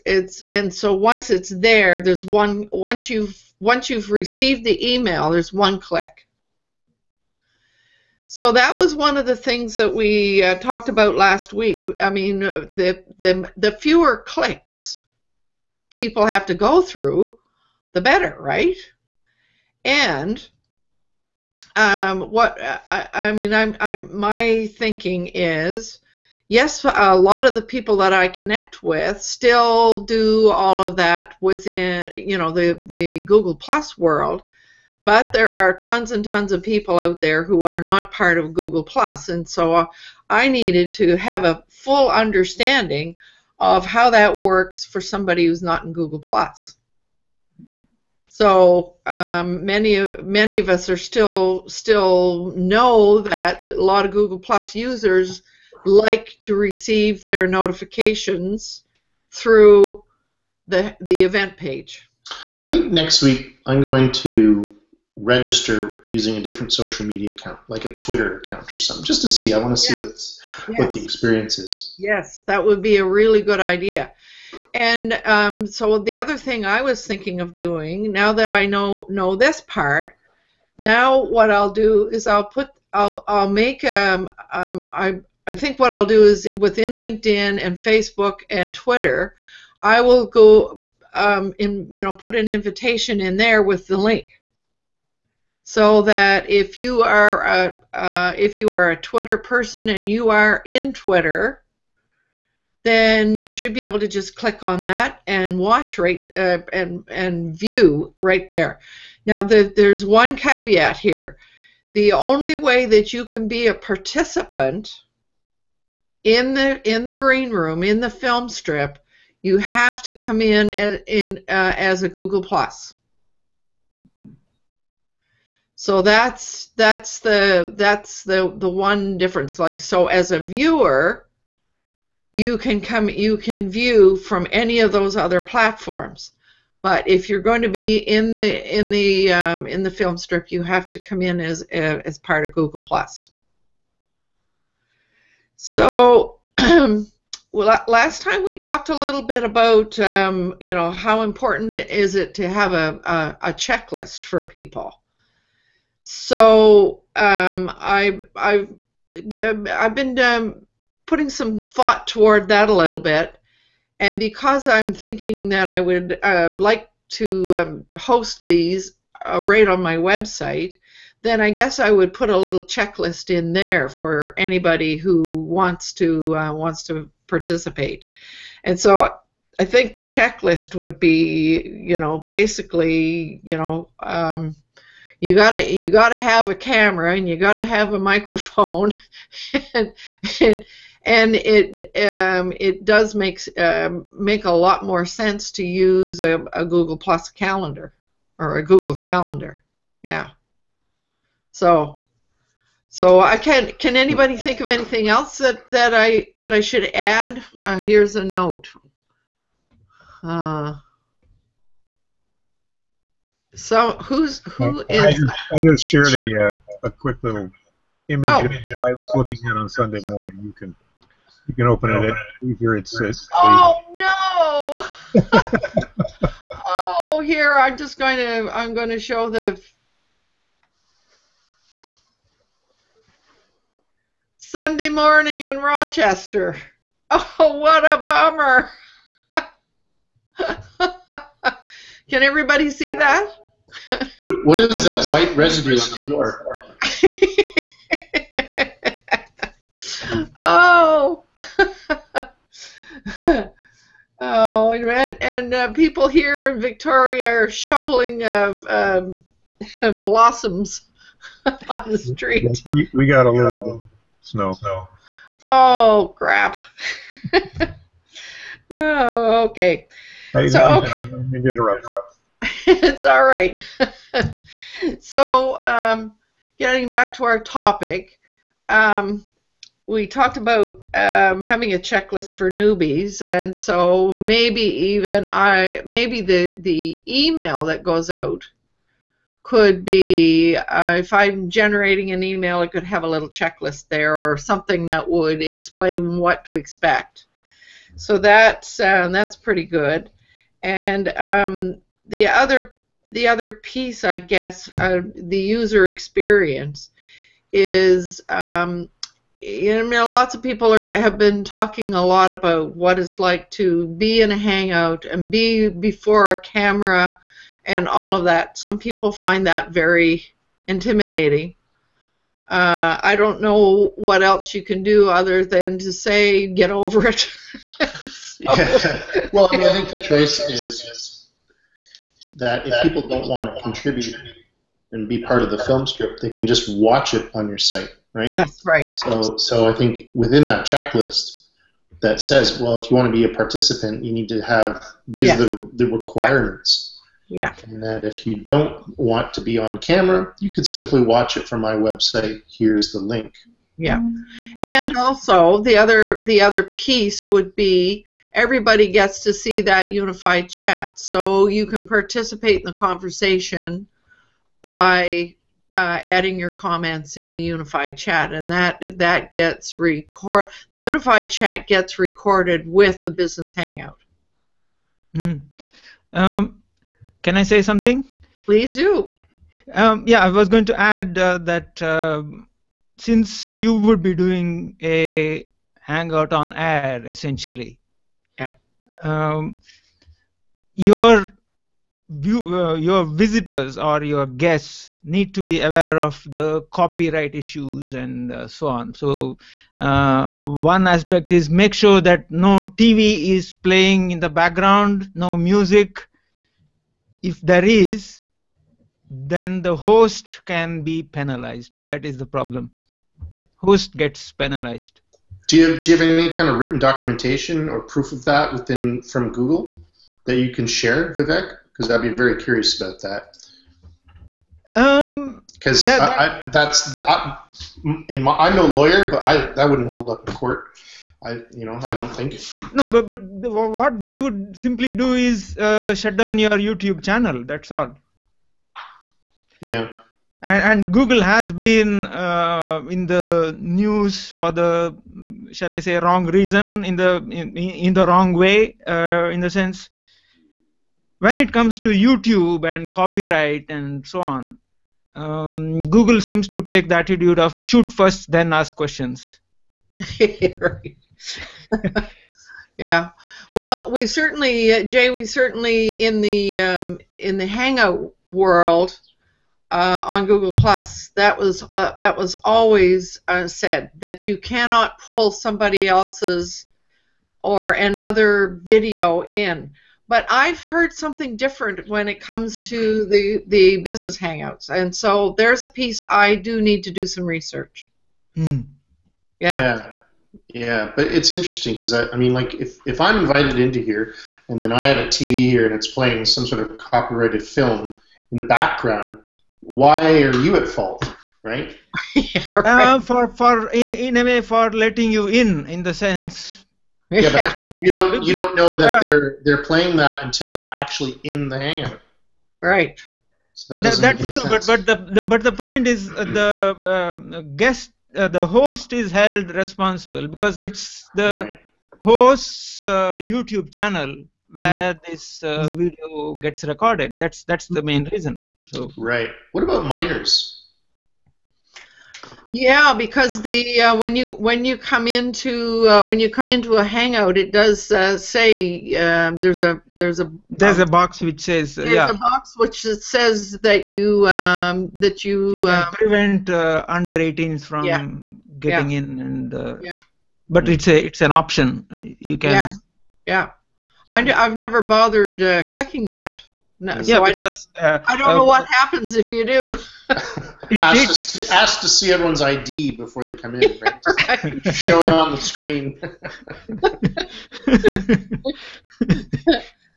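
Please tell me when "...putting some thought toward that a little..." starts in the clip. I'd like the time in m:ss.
2:41.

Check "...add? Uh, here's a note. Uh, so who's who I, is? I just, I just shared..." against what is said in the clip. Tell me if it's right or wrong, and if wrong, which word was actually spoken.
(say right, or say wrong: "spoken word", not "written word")
right.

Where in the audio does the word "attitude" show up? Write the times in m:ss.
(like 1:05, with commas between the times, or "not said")
7:36.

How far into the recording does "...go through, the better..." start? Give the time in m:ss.
0:16.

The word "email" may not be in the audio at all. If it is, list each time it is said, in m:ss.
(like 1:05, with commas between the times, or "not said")
0:04, 4:47, 4:52.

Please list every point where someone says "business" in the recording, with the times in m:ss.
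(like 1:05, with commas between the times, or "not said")
6:13, 8:03.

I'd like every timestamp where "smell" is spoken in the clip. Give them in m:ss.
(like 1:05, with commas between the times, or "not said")
not said.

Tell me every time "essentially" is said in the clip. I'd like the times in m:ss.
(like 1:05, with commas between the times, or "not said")
6:27.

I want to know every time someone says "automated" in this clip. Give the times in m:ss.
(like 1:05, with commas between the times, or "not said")
not said.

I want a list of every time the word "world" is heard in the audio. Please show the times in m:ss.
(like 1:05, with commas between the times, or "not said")
0:33, 7:48.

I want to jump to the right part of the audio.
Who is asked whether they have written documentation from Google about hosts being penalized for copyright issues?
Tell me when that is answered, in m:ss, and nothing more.
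7:01.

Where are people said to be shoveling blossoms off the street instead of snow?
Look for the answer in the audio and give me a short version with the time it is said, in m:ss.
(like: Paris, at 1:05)
Victoria, at 4:16.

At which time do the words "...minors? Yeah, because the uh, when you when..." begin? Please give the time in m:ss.
8:49.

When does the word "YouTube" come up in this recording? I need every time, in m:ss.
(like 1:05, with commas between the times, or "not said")
7:16, 7:31, 8:43.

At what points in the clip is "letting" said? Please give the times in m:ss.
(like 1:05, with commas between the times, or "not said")
8:24.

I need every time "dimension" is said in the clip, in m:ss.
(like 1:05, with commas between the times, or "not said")
not said.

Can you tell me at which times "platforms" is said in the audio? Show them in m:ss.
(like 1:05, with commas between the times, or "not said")
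2:15.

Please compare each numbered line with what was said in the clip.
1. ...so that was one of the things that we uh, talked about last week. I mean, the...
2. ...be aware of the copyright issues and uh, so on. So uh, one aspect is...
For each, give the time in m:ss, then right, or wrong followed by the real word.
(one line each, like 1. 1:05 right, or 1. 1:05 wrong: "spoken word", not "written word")
1. 0:08 right
2. 6:35 right.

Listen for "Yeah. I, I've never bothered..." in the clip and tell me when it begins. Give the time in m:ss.
9:13.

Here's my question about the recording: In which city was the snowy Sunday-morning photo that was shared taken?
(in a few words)
Rochester.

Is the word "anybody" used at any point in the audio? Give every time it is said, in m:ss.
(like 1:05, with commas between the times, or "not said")
2:54, 3:23.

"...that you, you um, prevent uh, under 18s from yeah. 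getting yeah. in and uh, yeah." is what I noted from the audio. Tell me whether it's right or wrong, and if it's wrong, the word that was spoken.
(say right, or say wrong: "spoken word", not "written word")
right.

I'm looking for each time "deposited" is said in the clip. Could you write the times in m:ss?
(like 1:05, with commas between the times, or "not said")
not said.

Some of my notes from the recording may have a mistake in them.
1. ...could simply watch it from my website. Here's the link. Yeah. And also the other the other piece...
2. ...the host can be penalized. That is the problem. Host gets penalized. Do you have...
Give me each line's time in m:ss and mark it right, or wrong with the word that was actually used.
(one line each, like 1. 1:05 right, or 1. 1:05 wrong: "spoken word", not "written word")
1. 5:50 right
2. 6:49 right.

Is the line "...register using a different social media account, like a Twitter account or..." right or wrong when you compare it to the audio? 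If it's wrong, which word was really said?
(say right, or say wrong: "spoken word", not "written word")
right.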